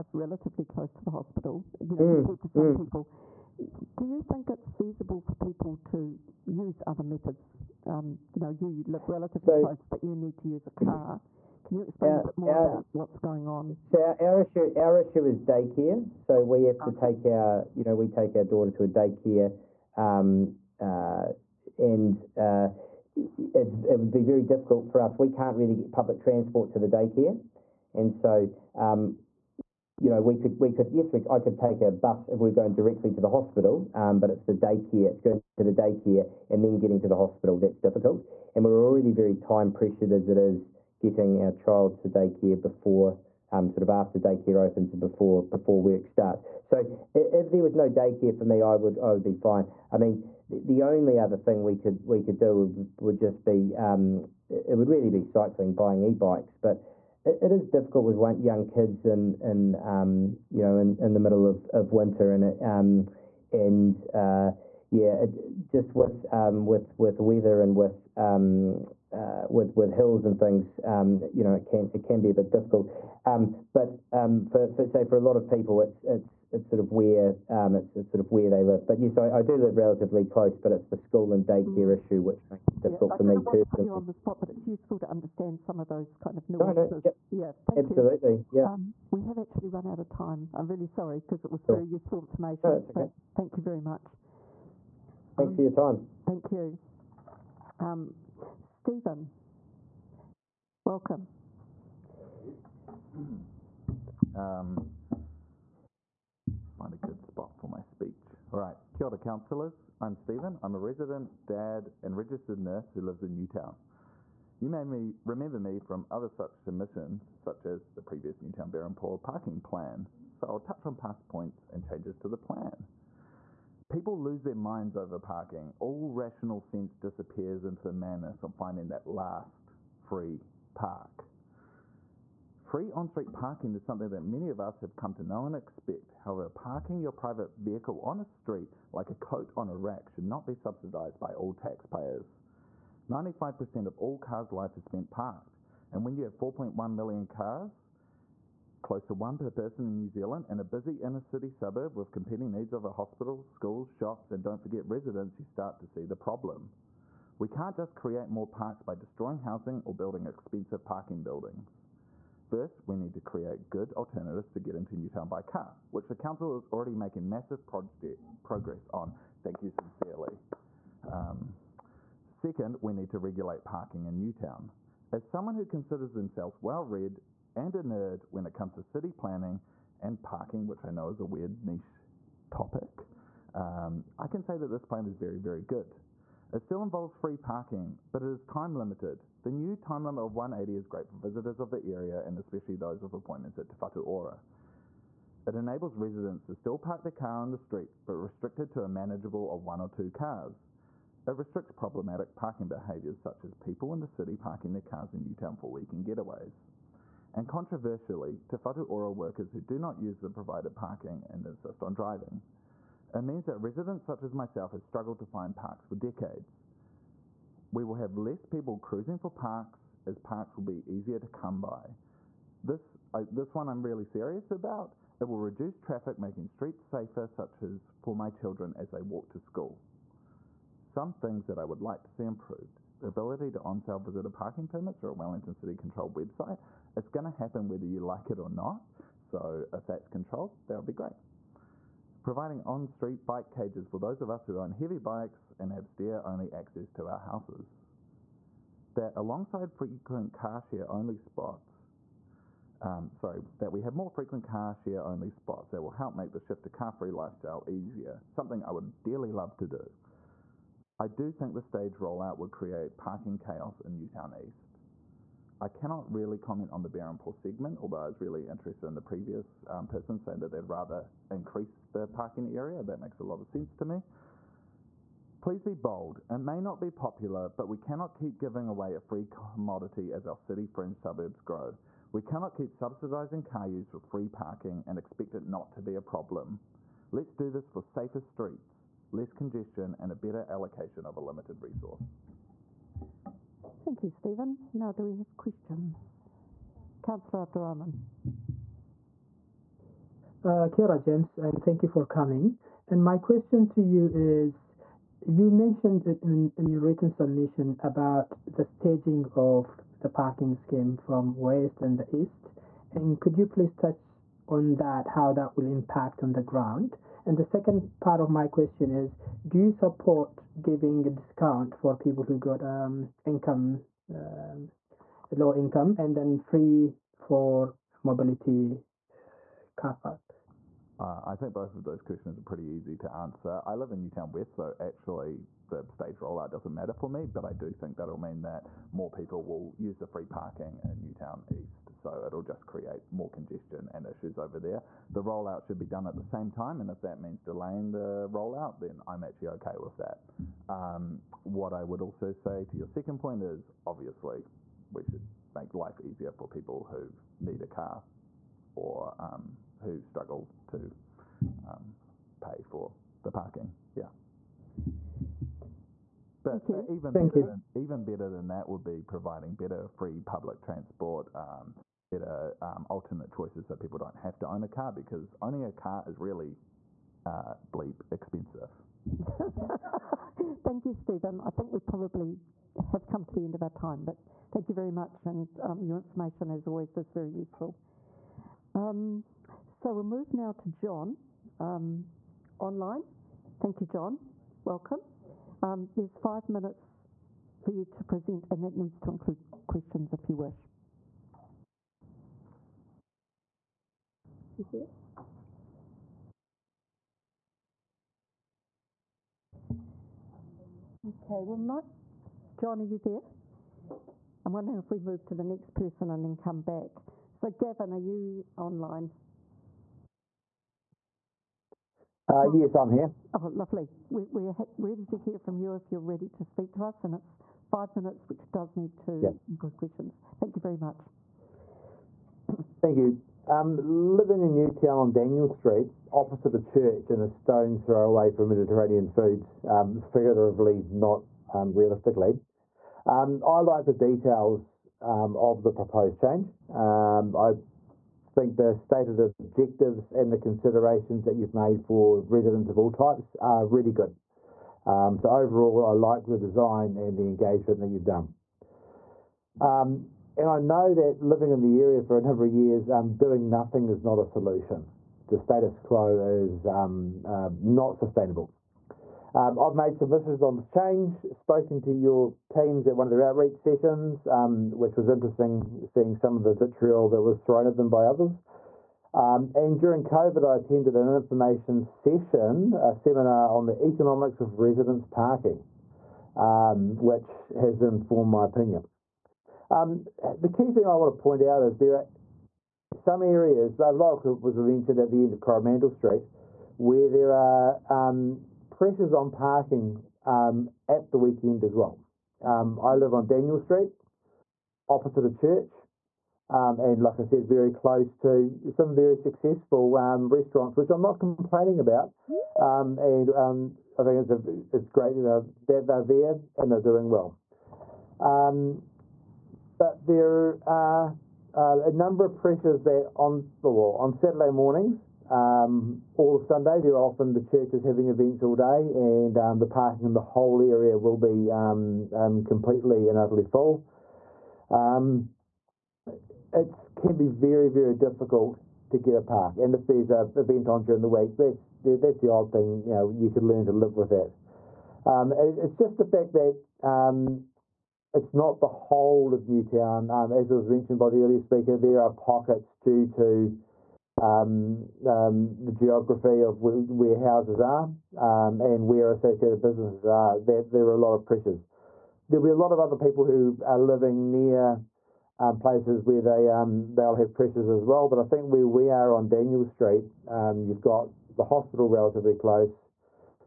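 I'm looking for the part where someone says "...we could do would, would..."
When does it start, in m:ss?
0:52.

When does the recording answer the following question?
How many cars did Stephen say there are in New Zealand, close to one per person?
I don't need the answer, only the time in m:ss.
2:26.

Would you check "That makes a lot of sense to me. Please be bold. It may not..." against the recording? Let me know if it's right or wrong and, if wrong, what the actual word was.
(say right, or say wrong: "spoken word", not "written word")
right.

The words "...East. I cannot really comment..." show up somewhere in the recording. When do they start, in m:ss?
4:24.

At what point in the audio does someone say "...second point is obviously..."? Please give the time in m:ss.
5:52.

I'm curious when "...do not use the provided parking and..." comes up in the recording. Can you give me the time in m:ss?
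3:29.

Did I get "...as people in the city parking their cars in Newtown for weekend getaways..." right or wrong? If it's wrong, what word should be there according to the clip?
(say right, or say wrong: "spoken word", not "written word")
right.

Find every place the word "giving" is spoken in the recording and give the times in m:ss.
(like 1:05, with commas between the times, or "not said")
4:38, 5:20.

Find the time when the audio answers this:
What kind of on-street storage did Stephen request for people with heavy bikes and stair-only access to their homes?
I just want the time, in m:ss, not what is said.
4:03.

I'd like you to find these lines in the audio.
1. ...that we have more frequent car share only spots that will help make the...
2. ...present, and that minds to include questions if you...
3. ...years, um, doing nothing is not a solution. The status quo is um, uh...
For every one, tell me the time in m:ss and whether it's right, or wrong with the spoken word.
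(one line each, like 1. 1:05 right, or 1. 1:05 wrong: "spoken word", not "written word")
1. 4:13 right
2. 6:38 wrong: "needs", not "minds"
3. 7:42 right.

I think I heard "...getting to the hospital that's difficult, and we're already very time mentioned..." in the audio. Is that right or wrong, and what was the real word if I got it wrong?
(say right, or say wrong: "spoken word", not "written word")
wrong: "pressured", not "mentioned".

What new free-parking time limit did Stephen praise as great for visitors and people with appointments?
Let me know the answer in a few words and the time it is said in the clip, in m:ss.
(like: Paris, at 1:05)
180, at 3:10.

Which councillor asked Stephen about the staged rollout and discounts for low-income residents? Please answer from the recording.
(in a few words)
Councillor Abdurahman.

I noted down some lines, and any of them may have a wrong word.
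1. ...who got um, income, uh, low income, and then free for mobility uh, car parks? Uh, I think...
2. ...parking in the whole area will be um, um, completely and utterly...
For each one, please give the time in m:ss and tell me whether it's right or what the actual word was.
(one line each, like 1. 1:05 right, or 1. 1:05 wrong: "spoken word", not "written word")
1. 5:22 right
2. 8:49 right.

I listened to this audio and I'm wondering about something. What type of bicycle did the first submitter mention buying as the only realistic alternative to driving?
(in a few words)
E-bikes.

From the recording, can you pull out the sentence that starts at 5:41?
So it'll just create more congestion and issues over there.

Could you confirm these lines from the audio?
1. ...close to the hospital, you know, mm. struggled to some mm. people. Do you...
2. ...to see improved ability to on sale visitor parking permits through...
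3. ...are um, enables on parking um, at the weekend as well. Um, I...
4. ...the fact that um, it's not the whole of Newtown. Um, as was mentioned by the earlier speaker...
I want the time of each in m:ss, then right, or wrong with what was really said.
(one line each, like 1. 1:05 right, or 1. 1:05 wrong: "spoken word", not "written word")
1. 0:00 wrong: "compared", not "struggled"
2. 3:52 right
3. 8:17 wrong: "pressures", not "enables"
4. 9:05 right.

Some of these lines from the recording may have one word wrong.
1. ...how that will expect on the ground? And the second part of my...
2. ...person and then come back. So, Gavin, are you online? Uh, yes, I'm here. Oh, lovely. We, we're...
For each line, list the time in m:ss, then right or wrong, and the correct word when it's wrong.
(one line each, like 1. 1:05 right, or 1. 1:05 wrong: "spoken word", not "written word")
1. 5:15 wrong: "impact", not "expect"
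2. 6:55 right.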